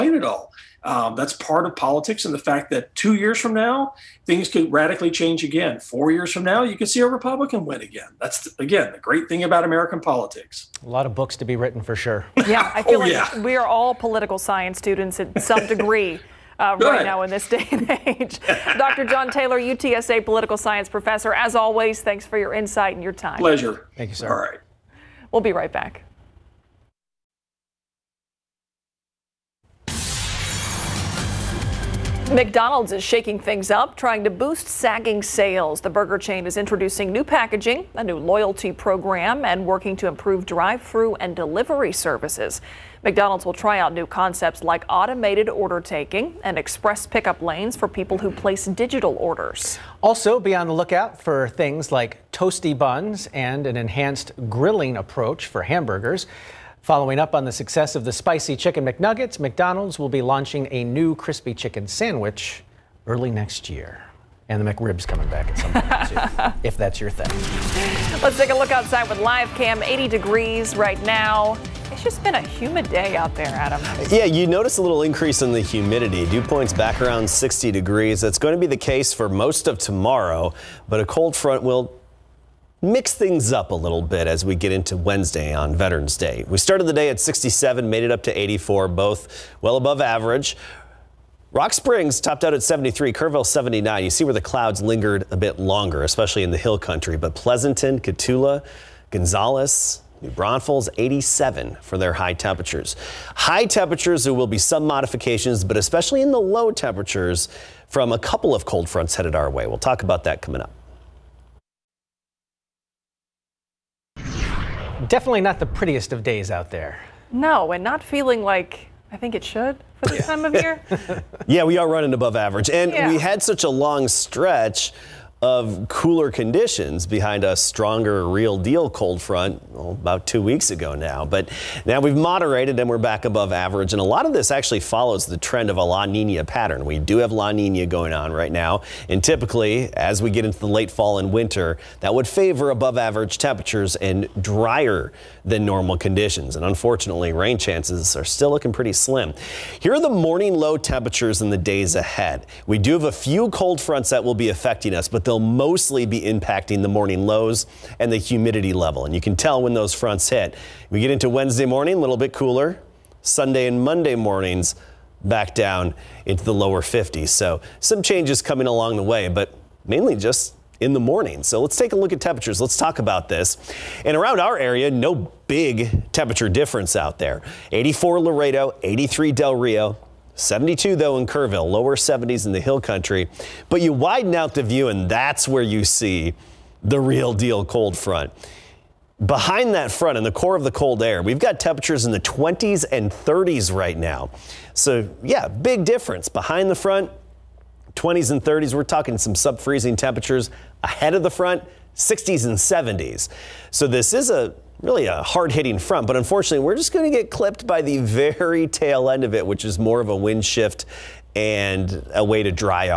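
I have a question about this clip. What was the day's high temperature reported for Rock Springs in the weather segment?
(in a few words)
73.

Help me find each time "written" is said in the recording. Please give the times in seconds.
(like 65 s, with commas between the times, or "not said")
11 s.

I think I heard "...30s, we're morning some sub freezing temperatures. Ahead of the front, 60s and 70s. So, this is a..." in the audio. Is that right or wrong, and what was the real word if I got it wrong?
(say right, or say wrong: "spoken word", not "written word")
wrong: "talking", not "morning".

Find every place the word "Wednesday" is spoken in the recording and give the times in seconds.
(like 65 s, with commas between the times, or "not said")
84 s, 161 s.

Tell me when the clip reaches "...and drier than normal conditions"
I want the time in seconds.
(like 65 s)
143 s.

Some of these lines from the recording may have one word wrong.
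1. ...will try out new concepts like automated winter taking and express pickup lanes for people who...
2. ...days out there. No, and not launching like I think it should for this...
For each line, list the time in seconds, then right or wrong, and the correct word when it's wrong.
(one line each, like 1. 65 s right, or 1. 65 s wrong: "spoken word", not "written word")
1. 43 s wrong: "order", not "winter"
2. 116 s wrong: "feeling", not "launching".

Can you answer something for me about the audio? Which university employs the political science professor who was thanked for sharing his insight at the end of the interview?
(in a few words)
UTSA.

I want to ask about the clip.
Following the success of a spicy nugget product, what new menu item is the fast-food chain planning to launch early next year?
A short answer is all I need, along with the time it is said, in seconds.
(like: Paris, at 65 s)
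crispy chicken sandwich, at 61 s.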